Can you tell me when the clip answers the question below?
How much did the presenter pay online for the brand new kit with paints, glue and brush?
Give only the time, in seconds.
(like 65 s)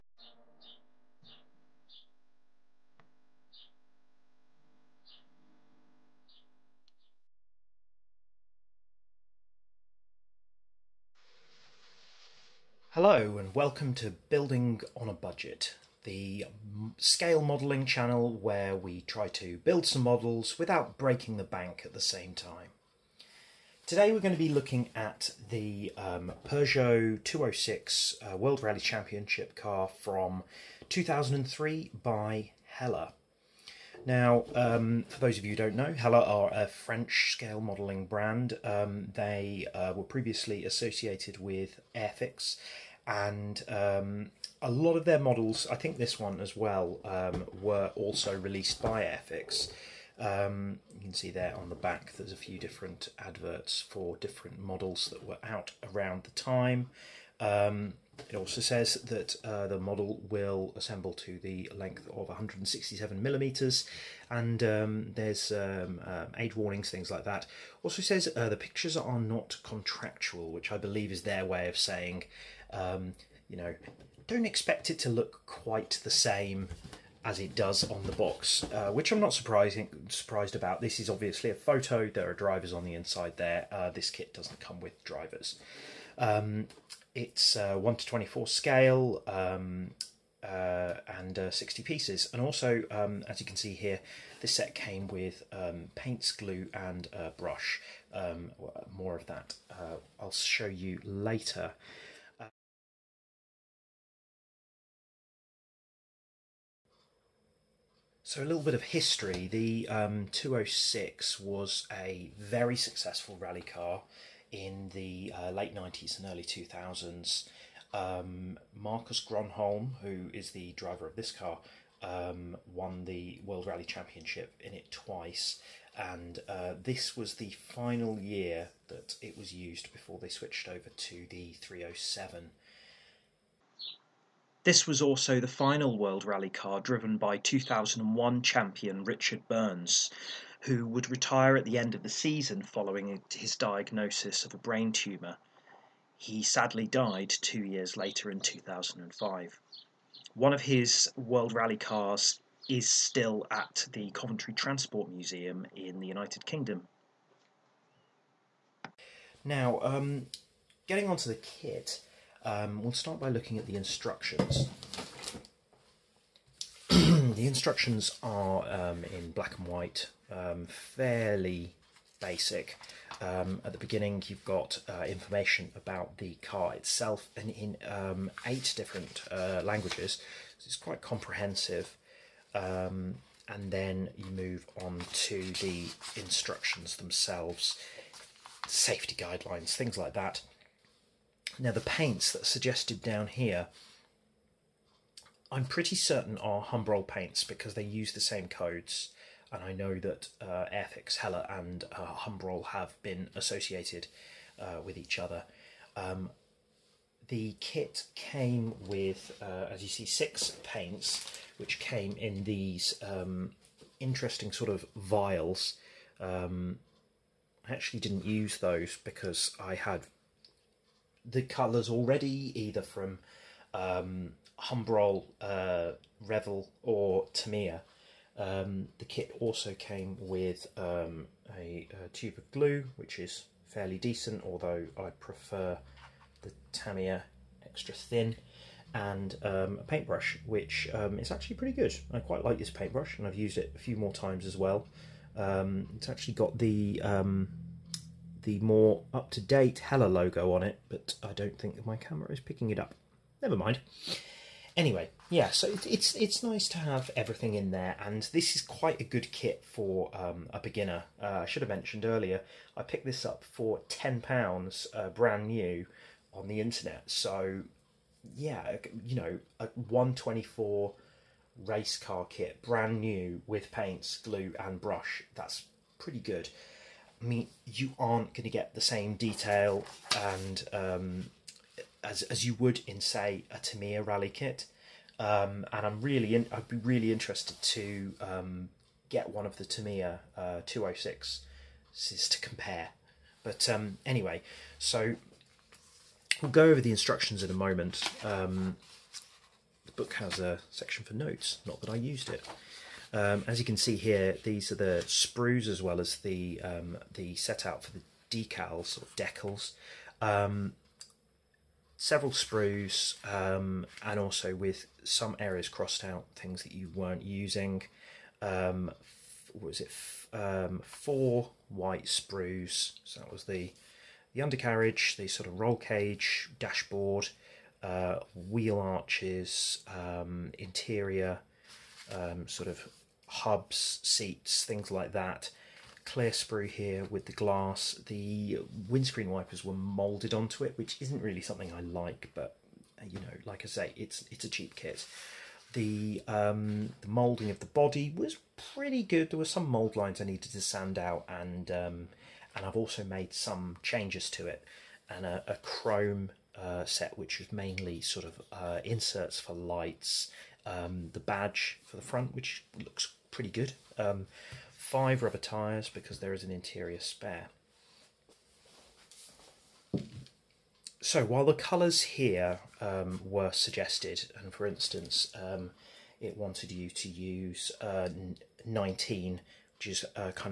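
263 s.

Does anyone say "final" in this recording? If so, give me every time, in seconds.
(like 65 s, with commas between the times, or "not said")
127 s, 135 s.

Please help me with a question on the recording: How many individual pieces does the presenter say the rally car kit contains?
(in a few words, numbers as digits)
60.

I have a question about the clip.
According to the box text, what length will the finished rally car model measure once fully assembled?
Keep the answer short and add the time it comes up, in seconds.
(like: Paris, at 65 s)
167 millimeters, at 62 s.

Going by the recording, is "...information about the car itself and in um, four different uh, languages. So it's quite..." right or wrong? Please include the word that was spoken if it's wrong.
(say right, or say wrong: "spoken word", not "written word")
wrong: "eight", not "four".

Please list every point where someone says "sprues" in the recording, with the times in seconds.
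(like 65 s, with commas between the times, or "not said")
305 s, 312 s, 322 s, 336 s.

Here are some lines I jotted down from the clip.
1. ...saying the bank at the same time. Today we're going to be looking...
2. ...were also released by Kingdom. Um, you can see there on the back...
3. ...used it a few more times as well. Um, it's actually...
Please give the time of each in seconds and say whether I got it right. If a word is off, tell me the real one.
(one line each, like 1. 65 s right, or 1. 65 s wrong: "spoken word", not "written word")
1. 20 s wrong: "breaking", not "saying"
2. 47 s wrong: "Airfix", not "Kingdom"
3. 243 s right.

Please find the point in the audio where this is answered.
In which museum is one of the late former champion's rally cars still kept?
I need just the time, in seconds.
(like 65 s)
154 s.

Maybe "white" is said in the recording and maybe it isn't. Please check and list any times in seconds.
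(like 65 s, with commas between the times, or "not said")
169 s, 321 s.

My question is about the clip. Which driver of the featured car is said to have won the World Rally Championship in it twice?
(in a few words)
Marcus Gronholm.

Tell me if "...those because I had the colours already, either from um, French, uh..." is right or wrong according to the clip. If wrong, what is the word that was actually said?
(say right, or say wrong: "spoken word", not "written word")
wrong: "Humbrol", not "French".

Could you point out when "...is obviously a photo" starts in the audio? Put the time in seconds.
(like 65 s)
80 s.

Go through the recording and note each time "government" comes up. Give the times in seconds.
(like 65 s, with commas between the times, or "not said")
not said.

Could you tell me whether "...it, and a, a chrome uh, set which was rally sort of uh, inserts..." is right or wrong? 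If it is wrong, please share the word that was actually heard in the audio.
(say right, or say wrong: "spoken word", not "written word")
wrong: "mainly", not "rally".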